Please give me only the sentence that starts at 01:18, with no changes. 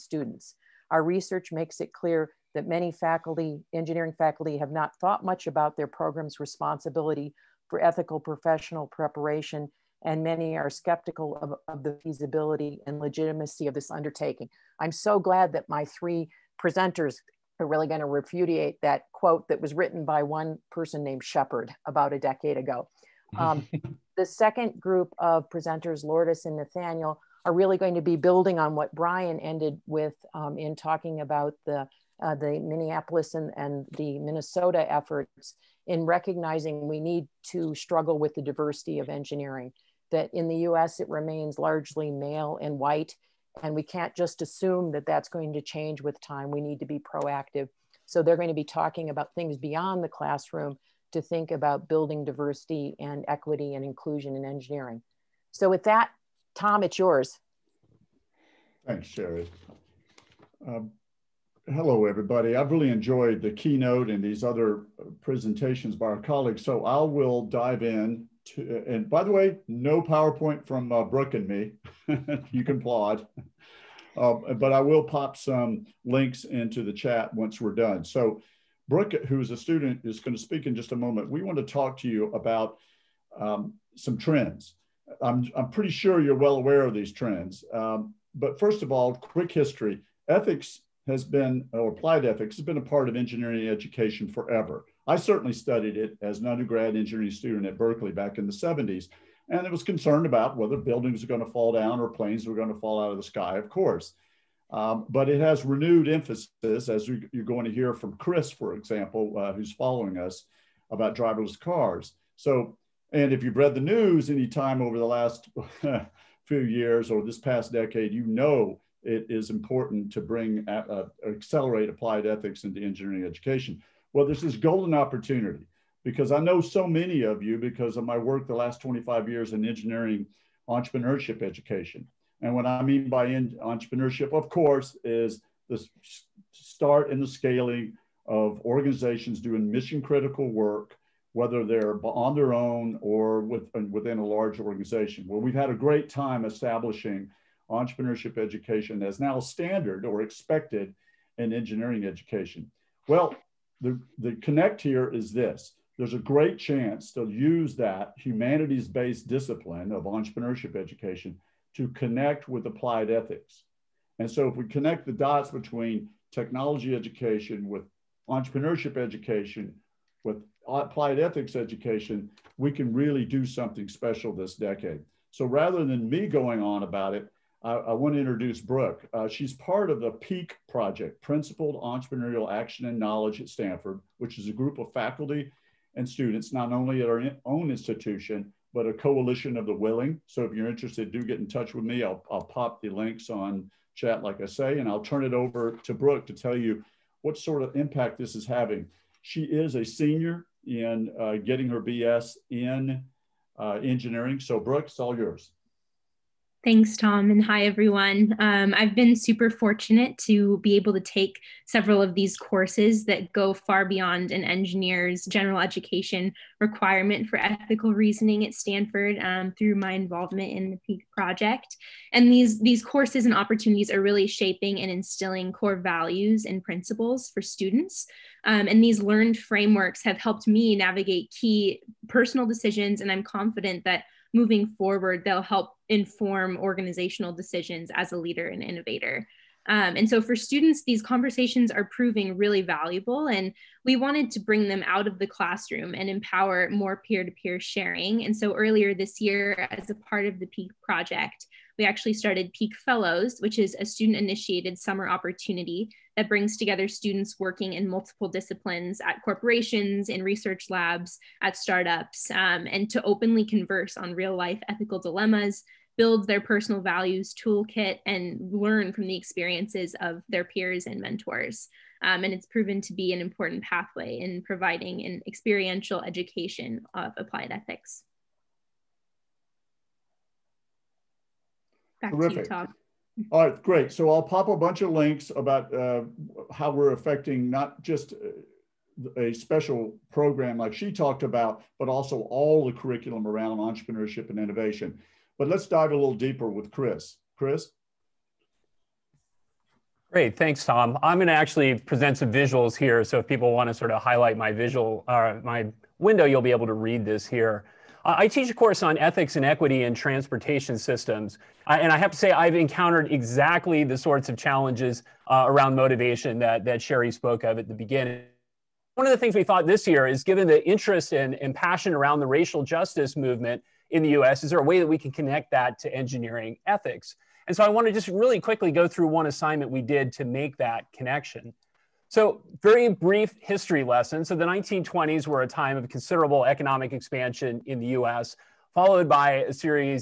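So Brooke, who is a student, is going to speak in just a moment.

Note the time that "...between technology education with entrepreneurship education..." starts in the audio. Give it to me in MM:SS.
02:45.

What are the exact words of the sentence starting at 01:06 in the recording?
So I will dive in to, and by the way, no PowerPoint from uh, Brooke and me.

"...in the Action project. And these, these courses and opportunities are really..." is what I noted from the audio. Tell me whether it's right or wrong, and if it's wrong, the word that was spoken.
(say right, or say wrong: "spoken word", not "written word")
wrong: "PEAK", not "Action".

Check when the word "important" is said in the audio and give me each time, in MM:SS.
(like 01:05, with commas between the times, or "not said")
01:59, 04:33.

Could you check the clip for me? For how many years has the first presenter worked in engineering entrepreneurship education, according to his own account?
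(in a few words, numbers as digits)
25.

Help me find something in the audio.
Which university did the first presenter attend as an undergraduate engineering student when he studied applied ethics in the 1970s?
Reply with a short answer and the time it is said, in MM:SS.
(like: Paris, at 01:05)
Berkeley, at 01:37.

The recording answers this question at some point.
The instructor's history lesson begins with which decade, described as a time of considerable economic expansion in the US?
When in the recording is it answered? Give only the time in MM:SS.
05:34.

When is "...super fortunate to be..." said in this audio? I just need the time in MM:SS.
03:29.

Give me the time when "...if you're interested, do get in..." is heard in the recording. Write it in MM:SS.
03:10.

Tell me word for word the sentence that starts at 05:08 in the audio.
I teach a course on ethics and equity in transportation systems.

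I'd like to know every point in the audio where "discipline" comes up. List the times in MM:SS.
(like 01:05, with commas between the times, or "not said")
02:39, 04:18.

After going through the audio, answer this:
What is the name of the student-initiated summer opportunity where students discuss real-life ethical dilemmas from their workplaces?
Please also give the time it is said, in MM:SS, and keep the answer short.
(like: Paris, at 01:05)
Peak Fellows, at 04:12.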